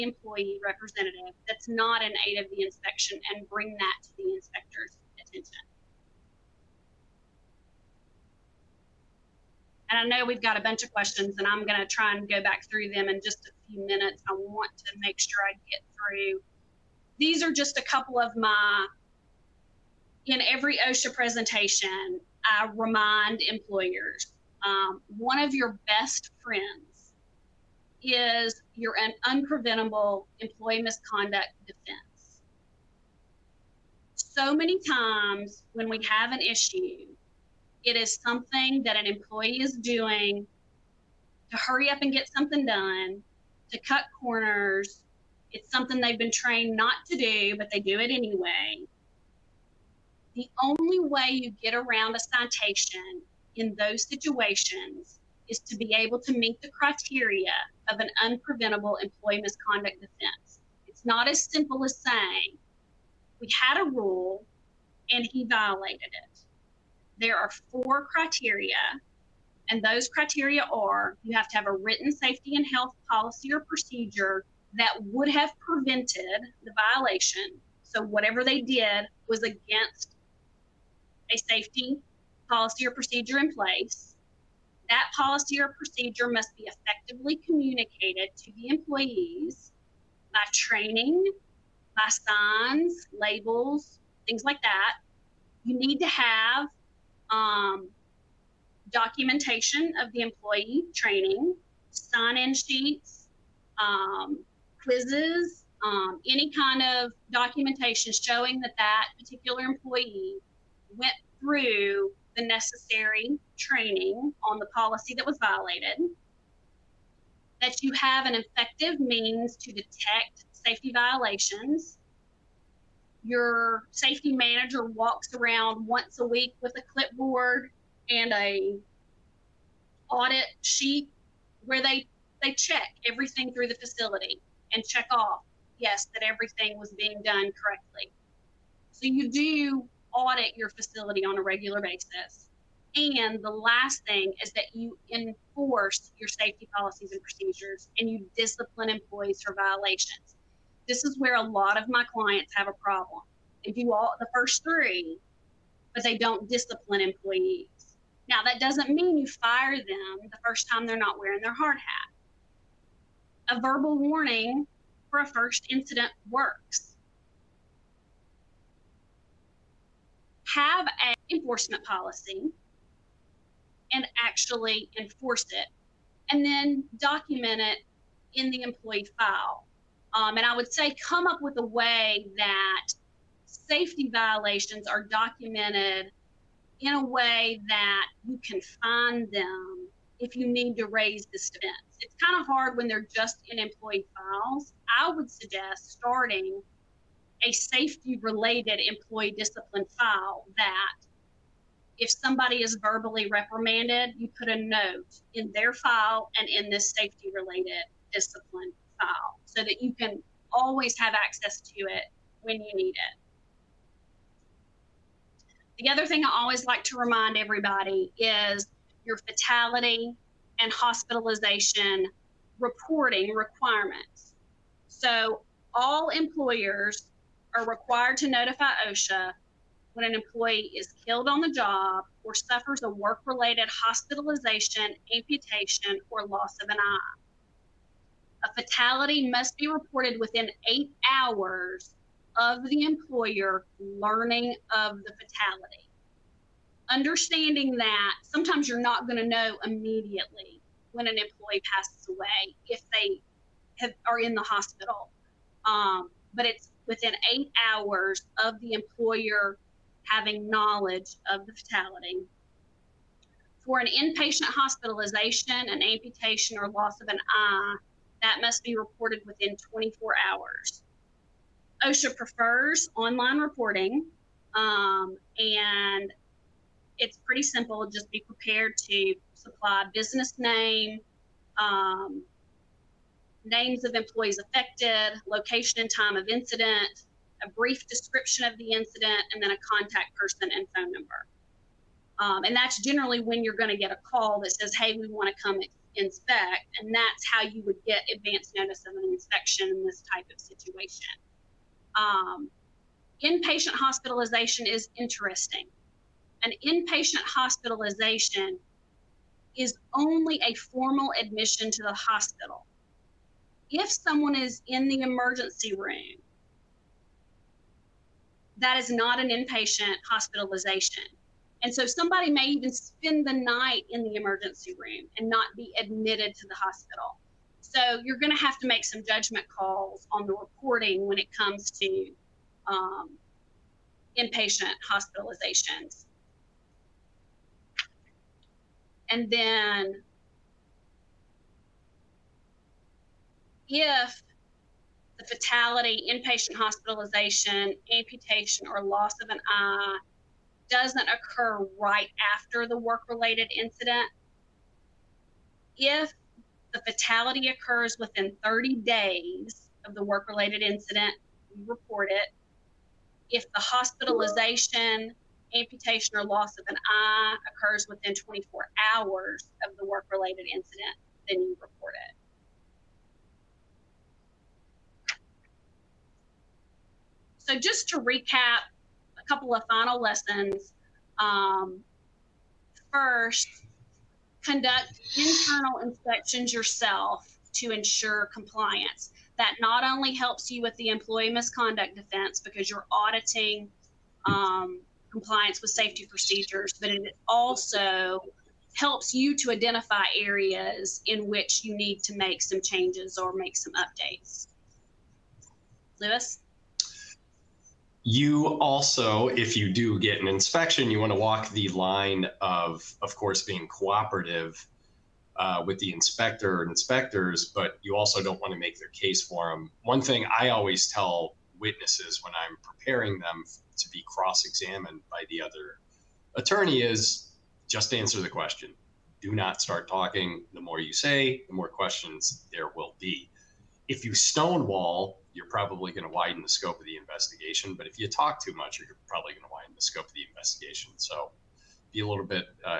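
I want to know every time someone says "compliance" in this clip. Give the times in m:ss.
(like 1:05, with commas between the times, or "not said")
6:28, 6:35.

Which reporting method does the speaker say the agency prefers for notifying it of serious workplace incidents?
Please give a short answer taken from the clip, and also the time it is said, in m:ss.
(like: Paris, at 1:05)
online reporting, at 4:32.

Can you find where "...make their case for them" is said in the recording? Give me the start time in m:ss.
6:58.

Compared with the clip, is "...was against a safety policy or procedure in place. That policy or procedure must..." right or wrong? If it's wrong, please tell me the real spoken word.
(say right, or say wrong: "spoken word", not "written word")
right.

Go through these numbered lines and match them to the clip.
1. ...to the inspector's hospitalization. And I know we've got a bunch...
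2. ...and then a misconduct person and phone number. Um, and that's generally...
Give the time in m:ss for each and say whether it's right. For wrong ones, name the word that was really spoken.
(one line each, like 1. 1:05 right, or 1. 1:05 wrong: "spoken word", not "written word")
1. 0:04 wrong: "attention", not "hospitalization"
2. 4:49 wrong: "contact", not "misconduct".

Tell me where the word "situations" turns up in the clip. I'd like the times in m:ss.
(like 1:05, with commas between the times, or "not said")
0:54, 5:00.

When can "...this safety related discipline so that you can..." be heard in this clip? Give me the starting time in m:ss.
3:26.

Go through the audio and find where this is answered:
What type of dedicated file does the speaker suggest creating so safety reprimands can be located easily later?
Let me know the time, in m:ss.
3:17.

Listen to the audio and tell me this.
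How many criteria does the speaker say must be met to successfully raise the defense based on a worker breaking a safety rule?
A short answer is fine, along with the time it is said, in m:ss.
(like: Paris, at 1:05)
4, at 1:07.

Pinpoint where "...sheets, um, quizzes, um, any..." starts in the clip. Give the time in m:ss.
1:42.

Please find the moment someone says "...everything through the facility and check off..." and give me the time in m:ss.
2:13.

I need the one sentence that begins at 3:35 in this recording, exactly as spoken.
The other thing I always like to remind everybody is your fatality and hospitalization reporting requirements.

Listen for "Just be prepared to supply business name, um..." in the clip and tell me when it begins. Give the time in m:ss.
4:37.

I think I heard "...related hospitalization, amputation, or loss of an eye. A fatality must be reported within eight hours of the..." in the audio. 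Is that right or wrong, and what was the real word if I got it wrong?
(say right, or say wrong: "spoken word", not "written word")
right.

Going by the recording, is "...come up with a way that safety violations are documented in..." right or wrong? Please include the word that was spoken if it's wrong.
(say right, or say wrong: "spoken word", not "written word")
right.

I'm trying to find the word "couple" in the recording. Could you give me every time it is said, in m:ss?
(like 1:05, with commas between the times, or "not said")
0:17, 6:19.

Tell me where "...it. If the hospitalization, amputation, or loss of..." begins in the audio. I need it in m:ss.
6:02.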